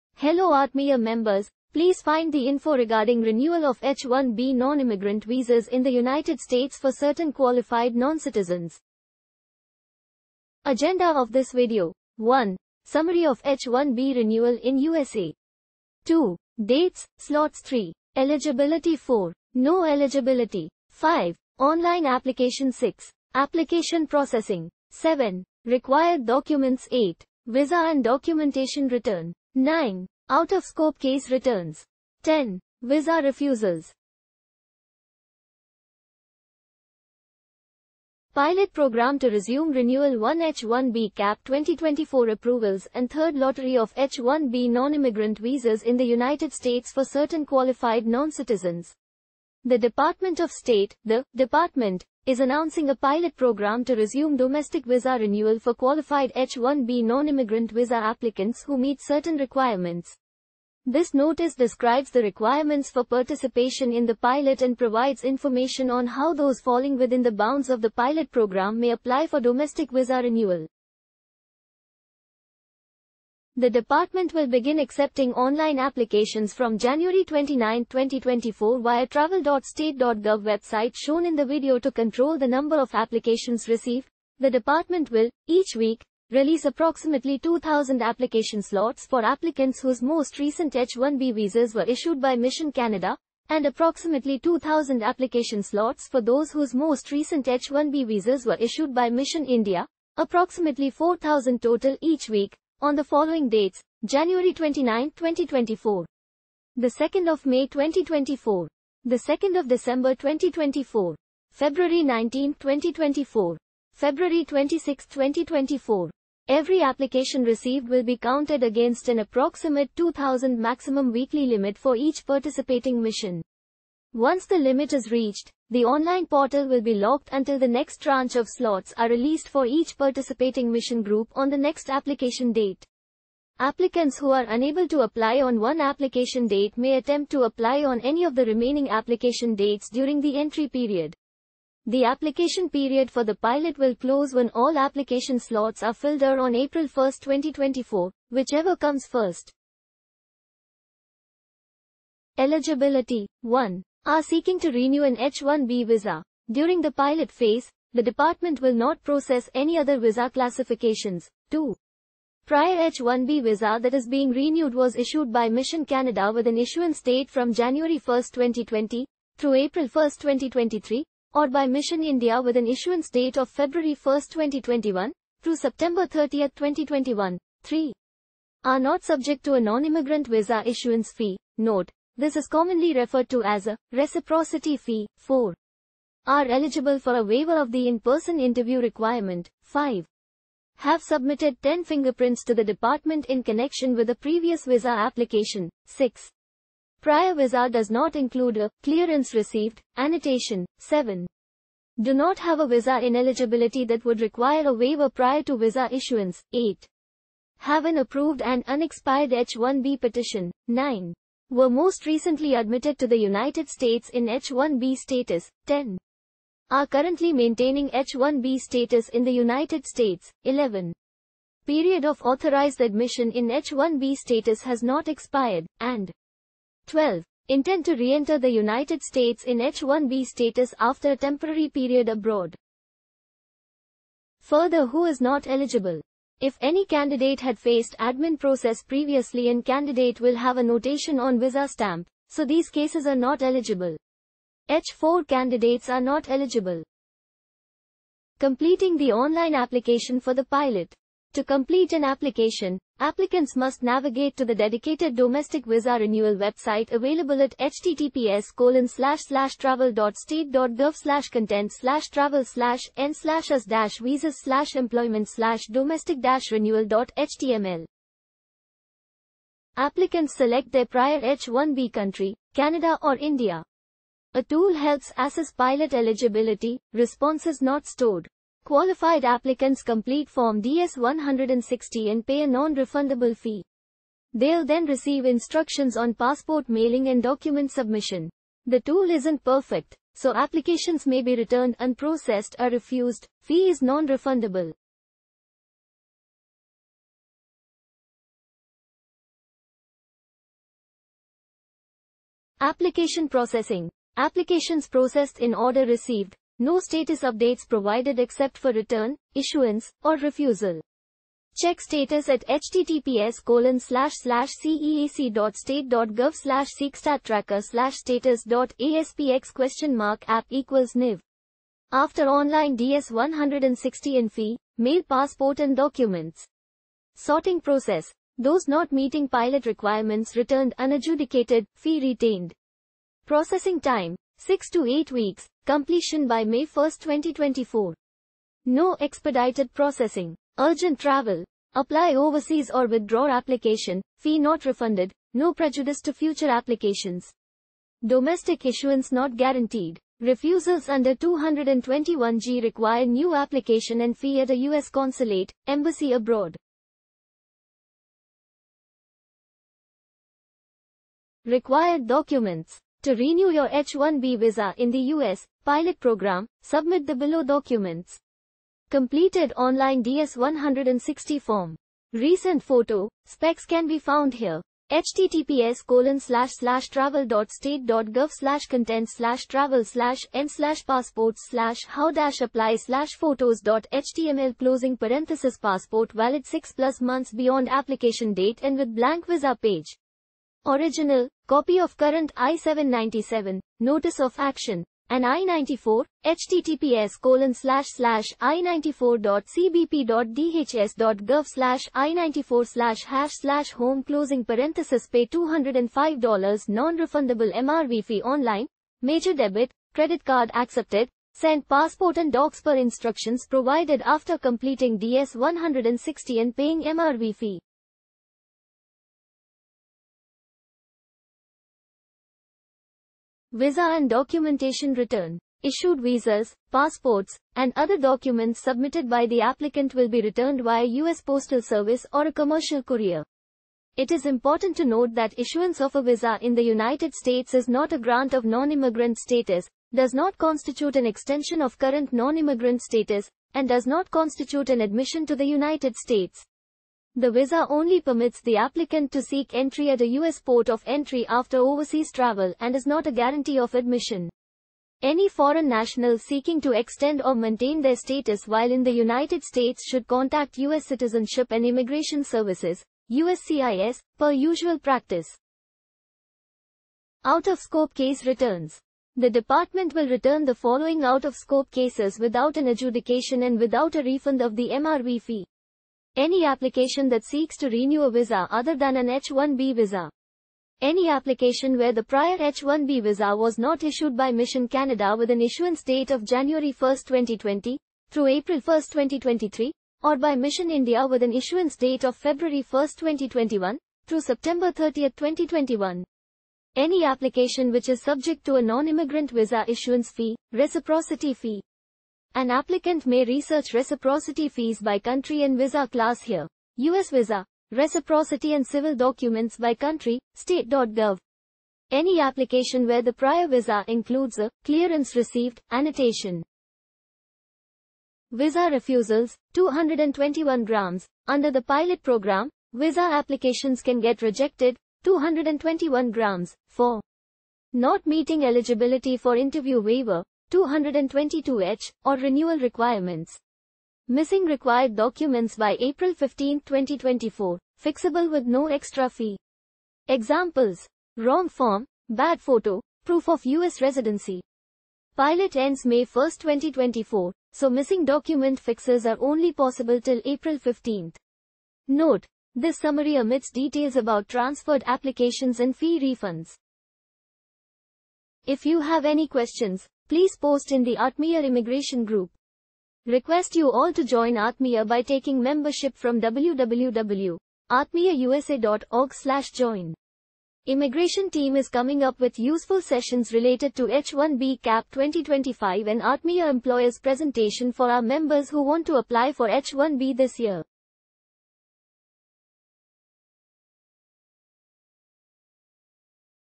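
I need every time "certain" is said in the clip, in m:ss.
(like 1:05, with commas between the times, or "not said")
0:06, 0:47, 0:59.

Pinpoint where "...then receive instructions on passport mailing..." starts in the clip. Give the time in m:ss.
4:44.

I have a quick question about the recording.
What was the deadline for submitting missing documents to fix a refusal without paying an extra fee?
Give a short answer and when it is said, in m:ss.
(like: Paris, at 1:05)
April 15, 2024, at 8:55.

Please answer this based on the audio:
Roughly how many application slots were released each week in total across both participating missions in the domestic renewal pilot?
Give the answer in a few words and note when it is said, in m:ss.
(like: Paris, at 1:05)
4,000, at 1:40.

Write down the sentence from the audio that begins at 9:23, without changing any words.
Request you all to join Atmiya by taking membership from www.atmiyausa.org slash join.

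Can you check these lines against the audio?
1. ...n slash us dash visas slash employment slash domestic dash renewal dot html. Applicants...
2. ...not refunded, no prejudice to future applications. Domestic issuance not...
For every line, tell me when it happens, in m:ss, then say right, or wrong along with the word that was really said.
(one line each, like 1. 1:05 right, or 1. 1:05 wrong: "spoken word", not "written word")
1. 4:22 right
2. 5:44 right.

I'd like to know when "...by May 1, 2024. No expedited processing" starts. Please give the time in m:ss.
5:36.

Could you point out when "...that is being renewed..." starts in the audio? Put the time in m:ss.
2:43.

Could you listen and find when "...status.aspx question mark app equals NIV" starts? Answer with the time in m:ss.
5:17.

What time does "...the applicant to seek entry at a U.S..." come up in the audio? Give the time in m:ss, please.
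7:28.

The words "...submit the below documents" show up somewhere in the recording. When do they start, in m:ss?
6:06.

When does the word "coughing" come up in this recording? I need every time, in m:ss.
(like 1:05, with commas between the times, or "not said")
not said.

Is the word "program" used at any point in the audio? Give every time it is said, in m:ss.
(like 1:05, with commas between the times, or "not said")
0:38, 0:53, 1:08, 6:05, 8:42.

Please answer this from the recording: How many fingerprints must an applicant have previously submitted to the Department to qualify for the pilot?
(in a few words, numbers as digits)
10.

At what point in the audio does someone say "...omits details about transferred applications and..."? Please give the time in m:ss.
9:13.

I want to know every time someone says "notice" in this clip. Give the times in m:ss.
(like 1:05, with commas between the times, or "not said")
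1:01, 6:33.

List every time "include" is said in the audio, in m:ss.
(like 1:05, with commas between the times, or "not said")
3:18, 8:33.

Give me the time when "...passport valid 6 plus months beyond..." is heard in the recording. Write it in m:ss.
6:25.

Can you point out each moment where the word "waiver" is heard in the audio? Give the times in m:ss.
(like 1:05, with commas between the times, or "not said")
3:07, 3:24, 8:49.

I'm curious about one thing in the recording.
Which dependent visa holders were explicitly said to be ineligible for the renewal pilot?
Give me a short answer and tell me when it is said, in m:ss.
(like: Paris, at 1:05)
H4 candidates, at 4:04.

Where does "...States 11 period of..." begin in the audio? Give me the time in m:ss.
3:39.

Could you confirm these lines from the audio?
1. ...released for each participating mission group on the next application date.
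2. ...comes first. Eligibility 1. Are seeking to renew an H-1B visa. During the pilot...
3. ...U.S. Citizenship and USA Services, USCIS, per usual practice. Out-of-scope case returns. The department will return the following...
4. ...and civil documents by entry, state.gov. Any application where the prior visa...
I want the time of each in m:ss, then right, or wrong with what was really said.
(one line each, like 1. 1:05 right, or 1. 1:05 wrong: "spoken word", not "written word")
1. 2:09 right
2. 2:28 right
3. 7:40 wrong: "Immigration", not "USA"
4. 8:28 wrong: "country", not "entry".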